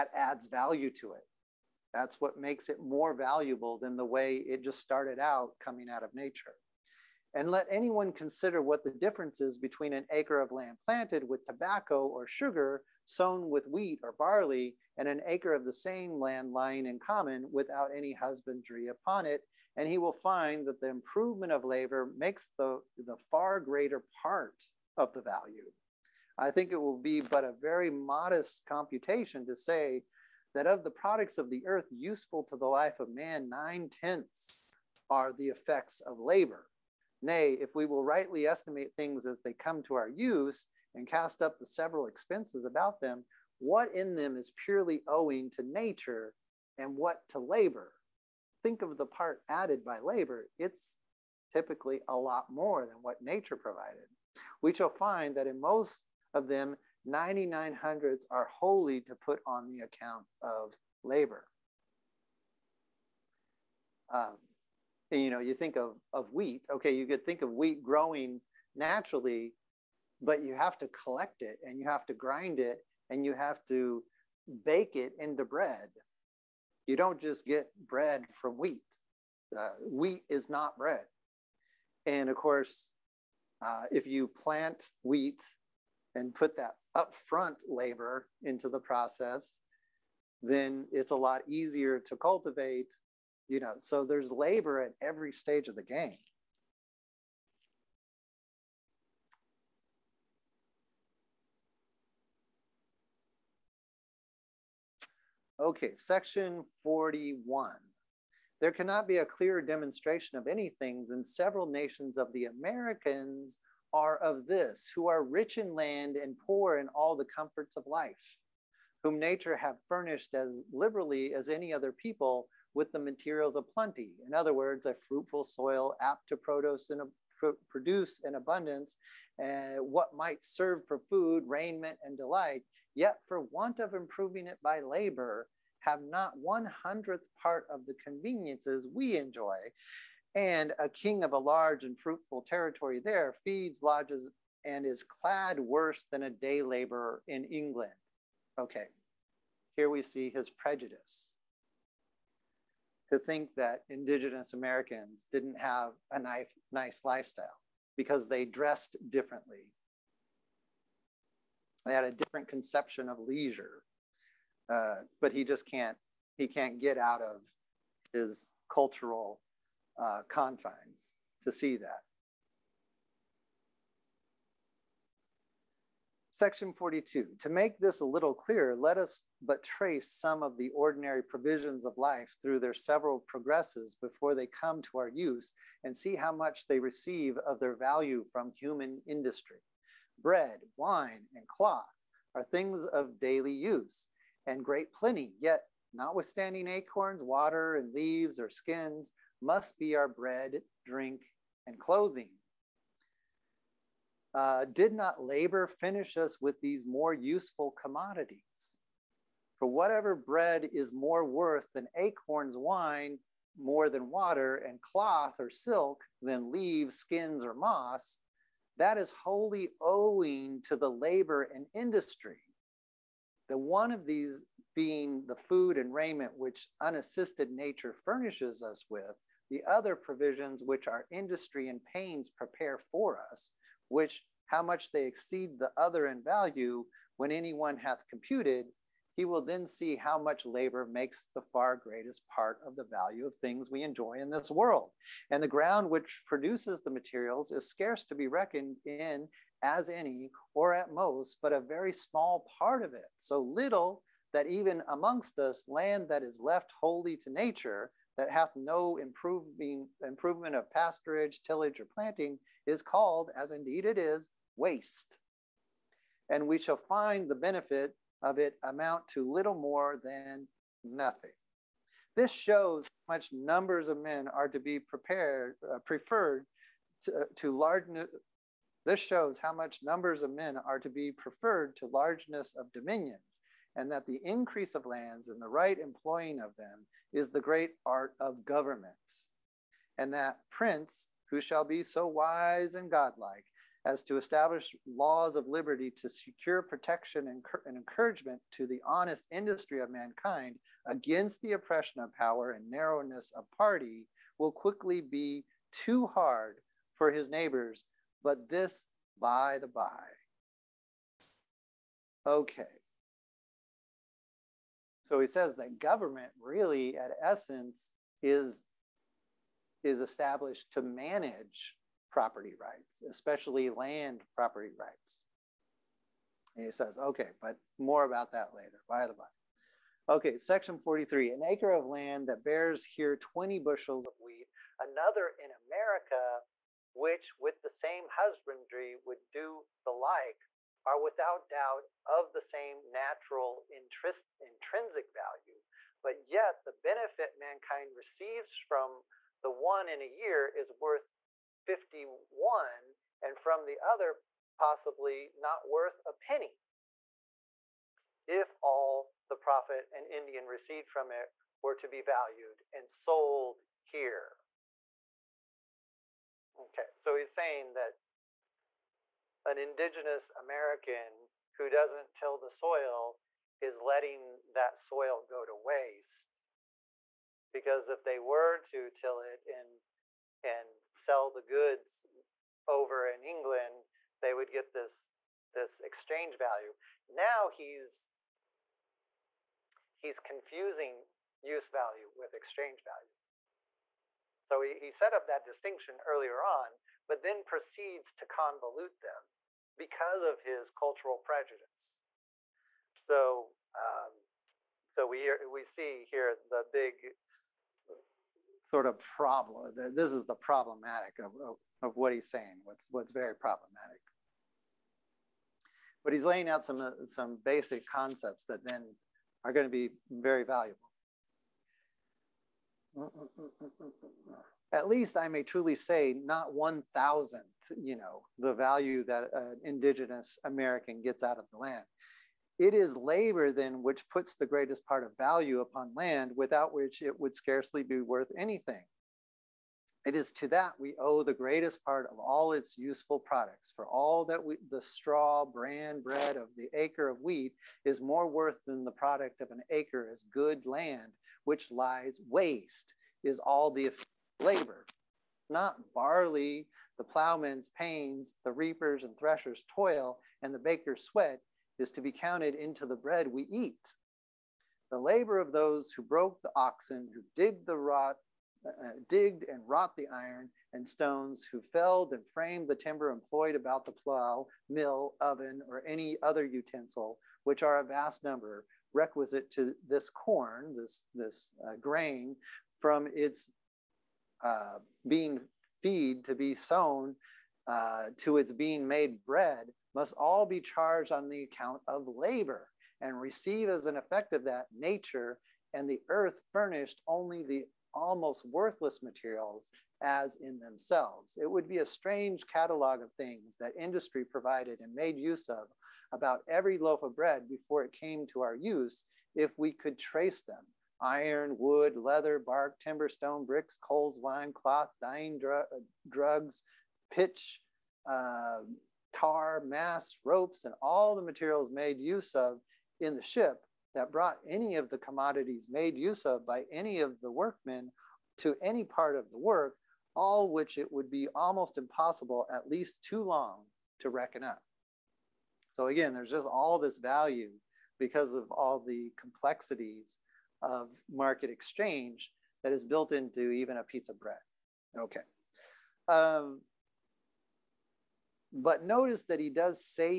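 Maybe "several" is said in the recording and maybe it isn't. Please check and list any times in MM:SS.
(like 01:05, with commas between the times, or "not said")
00:41, 01:51, 03:02.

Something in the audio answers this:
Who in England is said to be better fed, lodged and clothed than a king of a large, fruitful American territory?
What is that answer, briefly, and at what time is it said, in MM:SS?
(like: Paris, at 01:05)
a day laborer, at 02:26.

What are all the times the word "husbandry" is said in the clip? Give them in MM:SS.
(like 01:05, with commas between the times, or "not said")
00:18, 05:38.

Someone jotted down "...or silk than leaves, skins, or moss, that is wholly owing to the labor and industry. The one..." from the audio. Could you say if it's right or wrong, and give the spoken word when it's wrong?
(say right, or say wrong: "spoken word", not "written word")
right.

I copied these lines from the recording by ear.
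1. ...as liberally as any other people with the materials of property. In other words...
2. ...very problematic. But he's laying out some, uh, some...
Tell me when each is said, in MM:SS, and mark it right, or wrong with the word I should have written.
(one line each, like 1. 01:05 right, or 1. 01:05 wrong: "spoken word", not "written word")
1. 02:00 wrong: "plenty", not "property"
2. 06:53 right.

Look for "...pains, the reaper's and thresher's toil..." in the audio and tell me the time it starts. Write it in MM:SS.
07:37.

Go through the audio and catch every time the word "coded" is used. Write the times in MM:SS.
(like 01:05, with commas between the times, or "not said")
not said.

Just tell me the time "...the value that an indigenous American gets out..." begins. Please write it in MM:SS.
07:08.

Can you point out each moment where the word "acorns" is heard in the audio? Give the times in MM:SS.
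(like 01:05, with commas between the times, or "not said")
03:16, 03:31.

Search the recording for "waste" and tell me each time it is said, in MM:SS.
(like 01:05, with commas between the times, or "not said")
04:24, 06:15, 07:32.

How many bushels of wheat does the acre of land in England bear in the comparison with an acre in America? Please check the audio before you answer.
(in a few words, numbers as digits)
20.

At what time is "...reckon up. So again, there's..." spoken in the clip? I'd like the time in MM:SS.
08:54.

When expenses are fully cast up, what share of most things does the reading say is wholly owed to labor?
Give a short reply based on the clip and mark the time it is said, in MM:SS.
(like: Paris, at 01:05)
99 hundredths, at 00:57.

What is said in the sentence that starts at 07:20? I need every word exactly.
It is to that we owe the greatest part of all its useful products.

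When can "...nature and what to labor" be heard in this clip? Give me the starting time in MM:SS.
00:45.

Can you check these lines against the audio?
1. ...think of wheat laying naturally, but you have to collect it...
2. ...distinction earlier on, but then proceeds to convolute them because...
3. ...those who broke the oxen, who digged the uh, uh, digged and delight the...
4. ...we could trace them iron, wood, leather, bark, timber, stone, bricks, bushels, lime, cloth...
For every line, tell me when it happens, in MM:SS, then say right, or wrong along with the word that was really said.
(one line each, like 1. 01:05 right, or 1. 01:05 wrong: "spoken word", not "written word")
1. 01:07 wrong: "growing", not "laying"
2. 06:35 right
3. 07:45 wrong: "wrought", not "delight"
4. 08:29 wrong: "coals", not "bushels".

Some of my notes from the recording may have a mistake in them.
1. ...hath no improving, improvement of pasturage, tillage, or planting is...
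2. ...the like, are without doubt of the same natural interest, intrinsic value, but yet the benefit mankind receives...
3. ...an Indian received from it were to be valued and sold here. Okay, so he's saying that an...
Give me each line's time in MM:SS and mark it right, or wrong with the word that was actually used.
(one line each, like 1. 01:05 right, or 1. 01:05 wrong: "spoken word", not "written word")
1. 04:18 right
2. 05:39 right
3. 05:59 right.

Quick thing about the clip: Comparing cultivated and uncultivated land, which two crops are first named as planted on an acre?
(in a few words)
tobacco or sugar.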